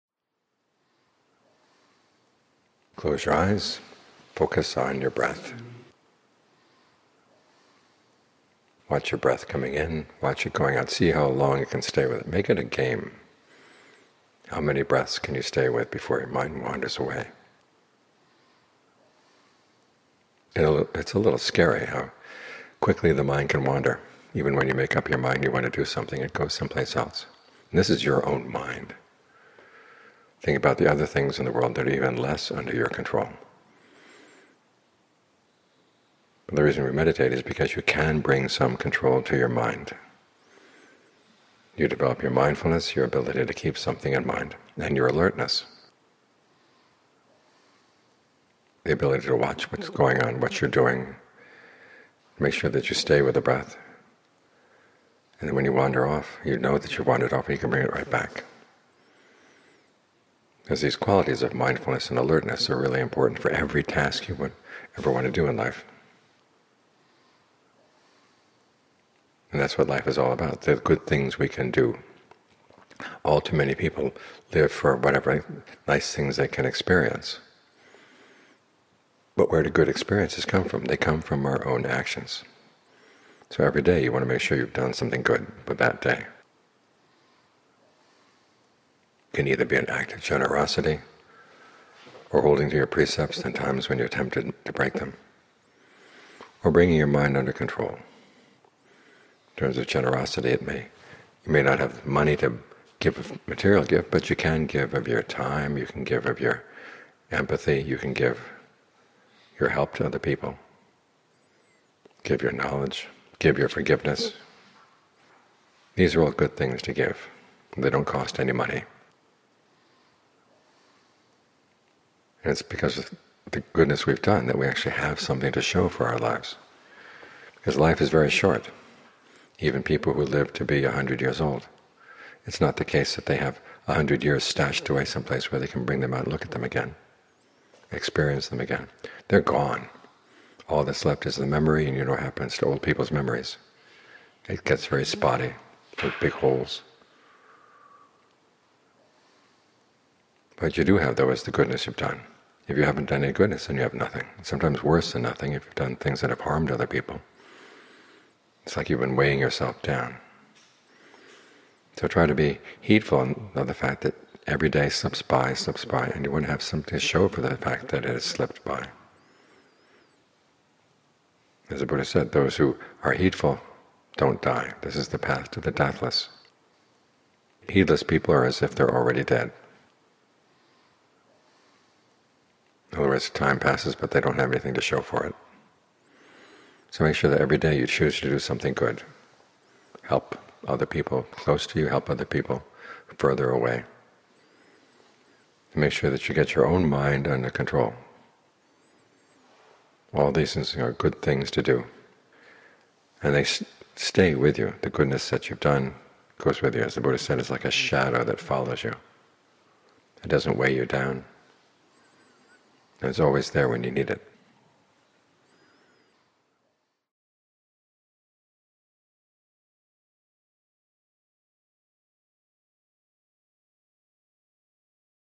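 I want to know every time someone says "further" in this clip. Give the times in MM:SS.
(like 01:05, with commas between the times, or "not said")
03:13.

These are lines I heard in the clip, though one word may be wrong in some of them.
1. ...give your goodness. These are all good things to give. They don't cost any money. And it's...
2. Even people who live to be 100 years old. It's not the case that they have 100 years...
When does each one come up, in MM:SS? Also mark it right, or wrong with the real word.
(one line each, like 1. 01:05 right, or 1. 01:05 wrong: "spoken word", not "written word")
1. 01:53 wrong: "forgiveness", not "goodness"
2. 02:09 right.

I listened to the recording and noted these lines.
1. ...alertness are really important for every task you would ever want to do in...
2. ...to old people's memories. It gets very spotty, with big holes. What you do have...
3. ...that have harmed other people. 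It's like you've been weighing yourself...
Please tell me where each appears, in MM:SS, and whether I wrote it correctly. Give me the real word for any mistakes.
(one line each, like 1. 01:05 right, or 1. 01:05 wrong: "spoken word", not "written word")
1. 01:02 right
2. 02:22 right
3. 02:36 right.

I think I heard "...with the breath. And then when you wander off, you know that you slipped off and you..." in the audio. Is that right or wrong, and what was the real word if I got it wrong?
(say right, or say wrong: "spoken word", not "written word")
wrong: "wandered", not "slipped".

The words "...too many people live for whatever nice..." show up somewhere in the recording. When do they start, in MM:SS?
01:13.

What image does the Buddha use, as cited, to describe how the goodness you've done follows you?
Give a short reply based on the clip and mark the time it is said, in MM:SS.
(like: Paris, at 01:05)
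a shadow, at 03:27.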